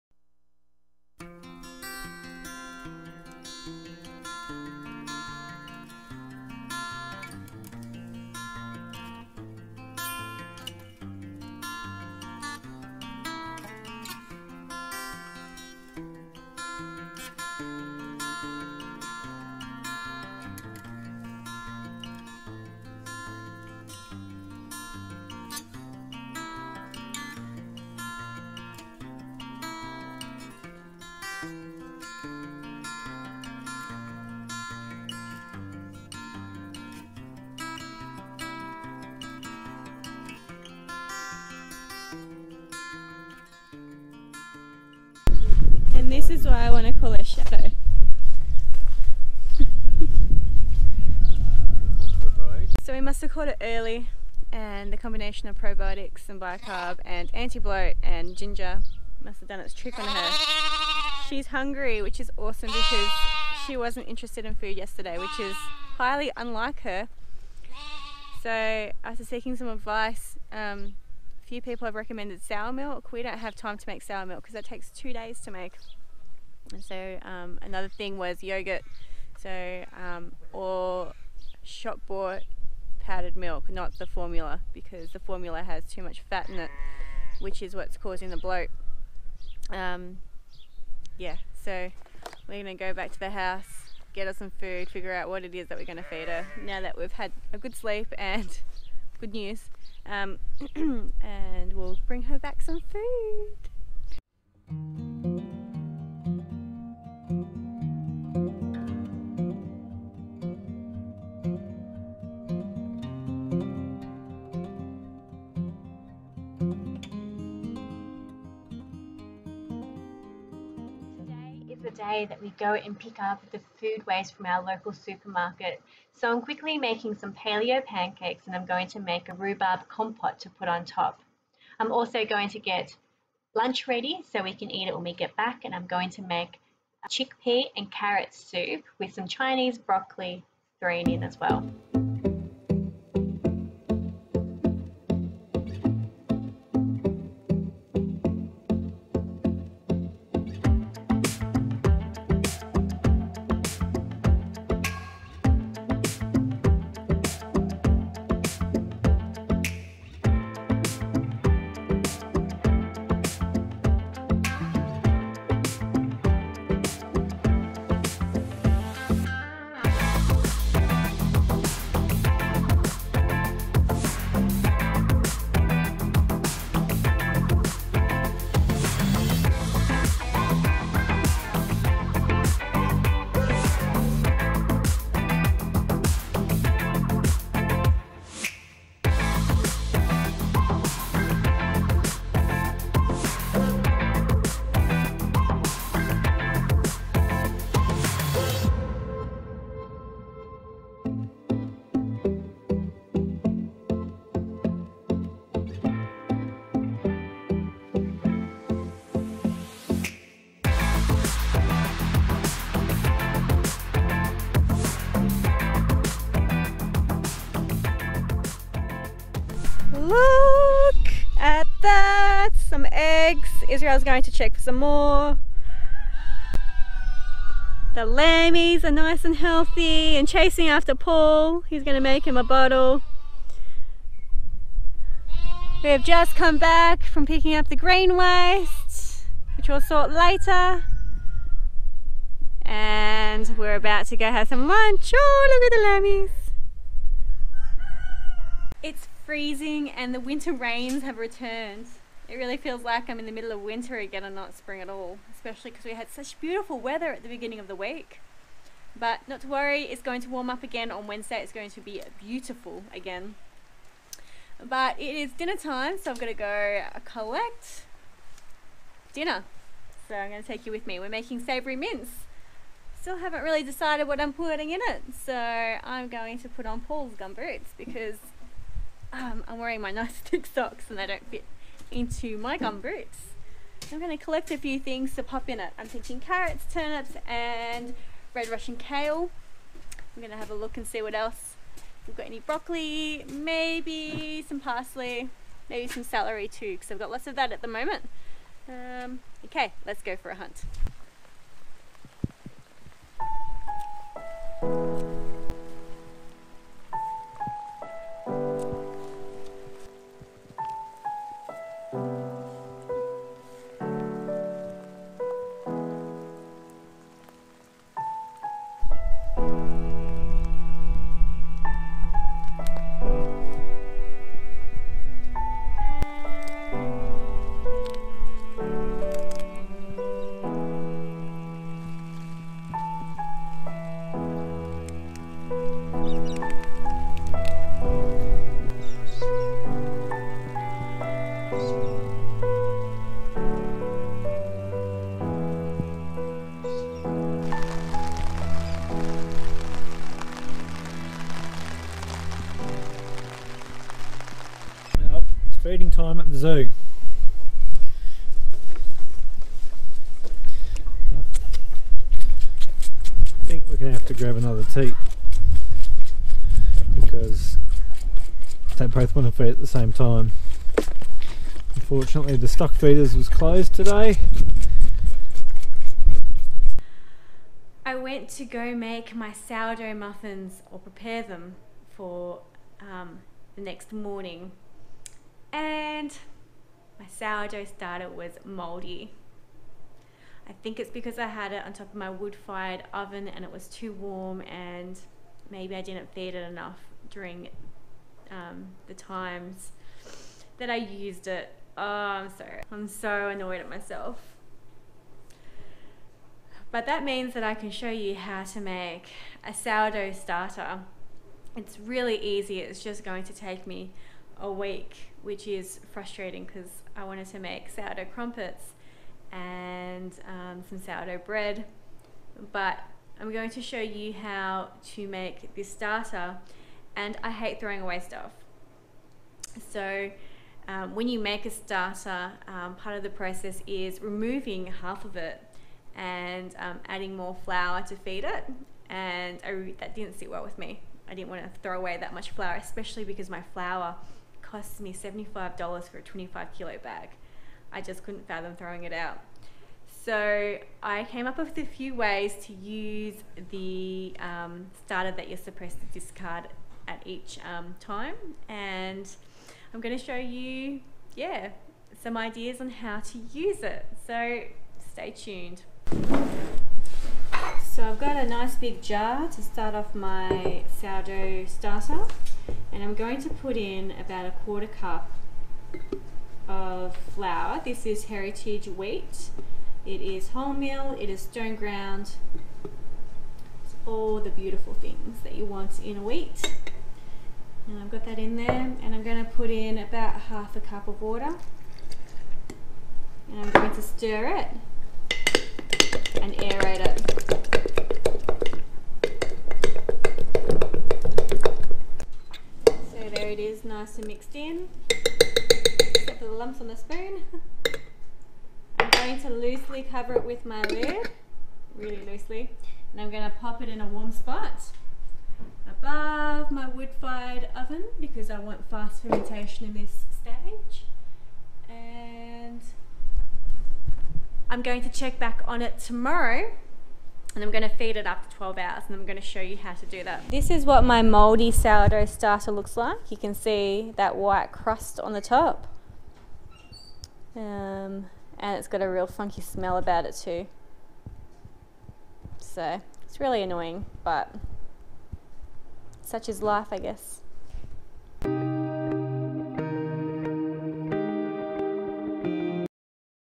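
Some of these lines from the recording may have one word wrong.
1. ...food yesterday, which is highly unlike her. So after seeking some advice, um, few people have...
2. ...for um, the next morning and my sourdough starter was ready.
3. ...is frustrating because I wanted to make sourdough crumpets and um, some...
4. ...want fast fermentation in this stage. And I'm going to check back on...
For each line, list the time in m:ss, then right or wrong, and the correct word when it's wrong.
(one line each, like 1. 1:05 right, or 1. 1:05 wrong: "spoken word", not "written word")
1. 1:04 right
2. 6:21 wrong: "moldy", not "ready"
3. 6:55 right
4. 8:38 right.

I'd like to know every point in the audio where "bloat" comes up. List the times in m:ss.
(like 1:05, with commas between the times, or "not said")
0:57, 1:28.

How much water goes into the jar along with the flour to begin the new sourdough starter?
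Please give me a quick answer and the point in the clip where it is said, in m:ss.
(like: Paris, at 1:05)
half a cup, at 8:10.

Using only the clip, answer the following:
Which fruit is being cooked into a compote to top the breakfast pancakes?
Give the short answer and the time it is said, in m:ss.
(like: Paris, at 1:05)
rhubarb, at 2:09.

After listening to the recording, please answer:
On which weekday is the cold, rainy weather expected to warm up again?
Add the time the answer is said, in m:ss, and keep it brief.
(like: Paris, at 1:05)
Wednesday, at 4:21.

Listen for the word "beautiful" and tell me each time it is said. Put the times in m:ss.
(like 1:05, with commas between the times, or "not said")
4:16, 4:22, 8:04.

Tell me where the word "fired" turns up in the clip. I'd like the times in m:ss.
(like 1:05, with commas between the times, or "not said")
6:32, 8:36.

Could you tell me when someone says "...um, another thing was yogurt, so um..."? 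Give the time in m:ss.
1:17.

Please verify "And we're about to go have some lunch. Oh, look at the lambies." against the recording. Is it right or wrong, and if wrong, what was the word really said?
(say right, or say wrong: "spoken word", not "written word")
right.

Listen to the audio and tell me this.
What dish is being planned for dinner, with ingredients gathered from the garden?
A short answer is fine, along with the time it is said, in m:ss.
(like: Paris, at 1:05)
savory mince, at 4:31.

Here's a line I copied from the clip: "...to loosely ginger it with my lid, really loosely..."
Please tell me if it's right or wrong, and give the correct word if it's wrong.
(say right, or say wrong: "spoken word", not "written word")
wrong: "cover", not "ginger".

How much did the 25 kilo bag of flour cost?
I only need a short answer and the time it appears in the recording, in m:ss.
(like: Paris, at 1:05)
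$75, at 7:24.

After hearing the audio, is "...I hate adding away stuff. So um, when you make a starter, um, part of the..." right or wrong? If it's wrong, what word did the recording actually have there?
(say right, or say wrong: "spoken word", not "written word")
wrong: "throwing", not "adding".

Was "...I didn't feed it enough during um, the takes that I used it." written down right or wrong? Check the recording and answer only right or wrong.
wrong.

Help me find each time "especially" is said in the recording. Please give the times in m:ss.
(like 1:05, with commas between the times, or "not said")
4:15, 7:22.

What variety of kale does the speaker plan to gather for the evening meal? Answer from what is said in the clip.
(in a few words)
red Russian kale.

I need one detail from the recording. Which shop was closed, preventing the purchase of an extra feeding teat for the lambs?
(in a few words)
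the stock feeders.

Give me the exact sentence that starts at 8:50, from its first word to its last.
This is what my mouldy sourdough starter looks like.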